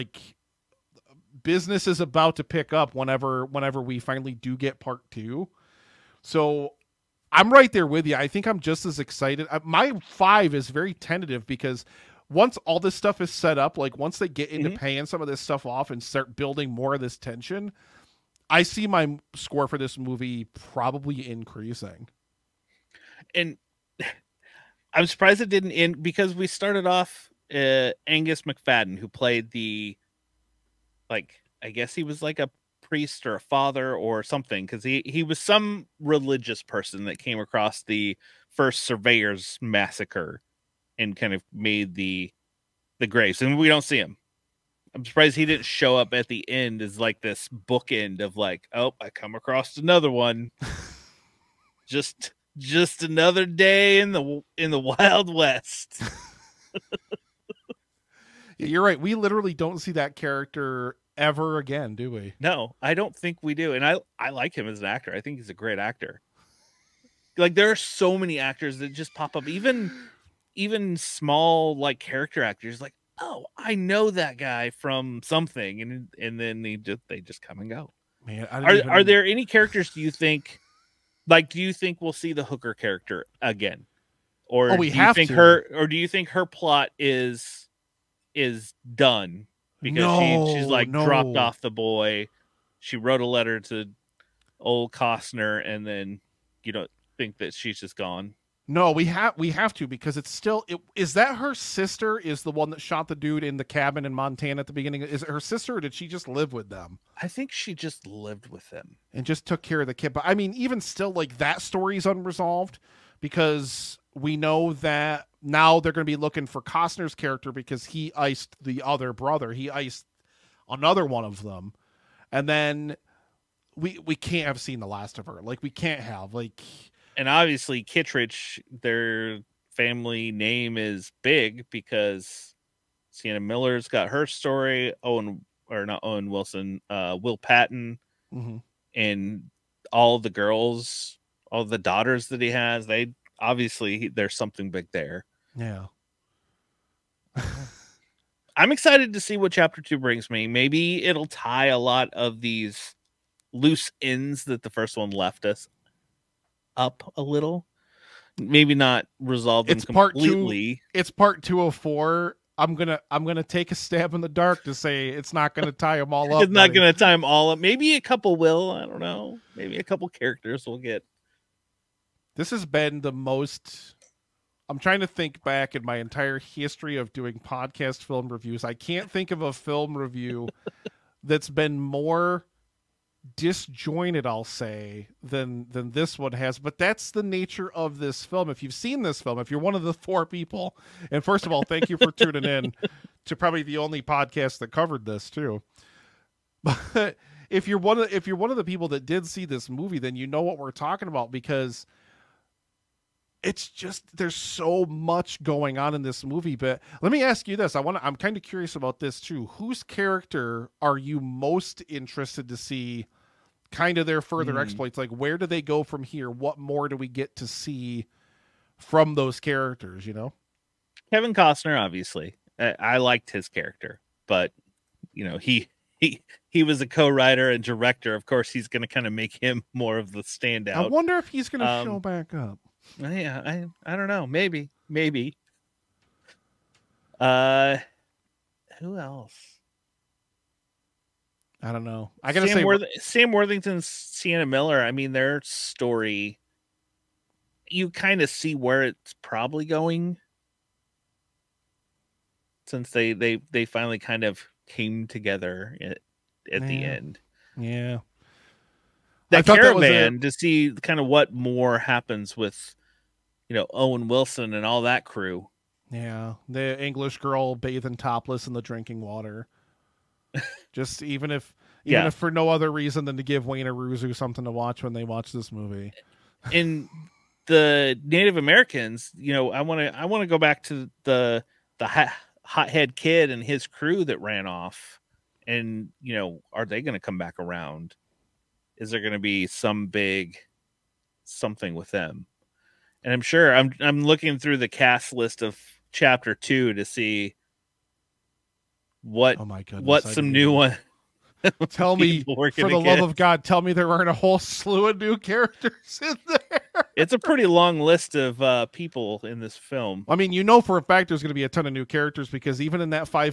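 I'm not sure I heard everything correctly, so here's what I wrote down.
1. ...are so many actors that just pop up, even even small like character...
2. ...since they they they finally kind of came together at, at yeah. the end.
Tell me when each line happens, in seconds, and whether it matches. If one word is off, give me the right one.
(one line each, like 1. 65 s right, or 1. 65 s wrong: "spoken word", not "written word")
1. 67 s right
2. 252 s right.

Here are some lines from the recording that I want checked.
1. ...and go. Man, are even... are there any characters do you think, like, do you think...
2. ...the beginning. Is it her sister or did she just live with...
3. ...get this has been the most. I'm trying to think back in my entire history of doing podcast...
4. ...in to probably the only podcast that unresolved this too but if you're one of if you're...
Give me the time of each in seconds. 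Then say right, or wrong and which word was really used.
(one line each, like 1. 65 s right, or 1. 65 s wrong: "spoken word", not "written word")
1. 77 s right
2. 104 s right
3. 170 s right
4. 192 s wrong: "covered", not "unresolved".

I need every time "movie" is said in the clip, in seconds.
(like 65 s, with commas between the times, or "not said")
19 s, 199 s, 206 s, 275 s.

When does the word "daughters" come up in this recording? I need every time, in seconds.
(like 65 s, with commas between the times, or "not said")
141 s.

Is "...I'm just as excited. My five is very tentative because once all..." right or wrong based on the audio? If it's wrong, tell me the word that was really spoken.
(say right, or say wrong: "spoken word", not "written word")
right.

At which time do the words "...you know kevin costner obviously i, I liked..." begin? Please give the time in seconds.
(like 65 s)
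220 s.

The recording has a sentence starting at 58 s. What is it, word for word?
We literally don't see that character ever again, do we?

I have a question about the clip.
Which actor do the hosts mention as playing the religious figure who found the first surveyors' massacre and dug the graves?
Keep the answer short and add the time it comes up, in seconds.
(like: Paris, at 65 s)
Angus Macfadyen, at 28 s.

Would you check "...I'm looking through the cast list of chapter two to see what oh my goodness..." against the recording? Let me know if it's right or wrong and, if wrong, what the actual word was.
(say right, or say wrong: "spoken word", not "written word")
right.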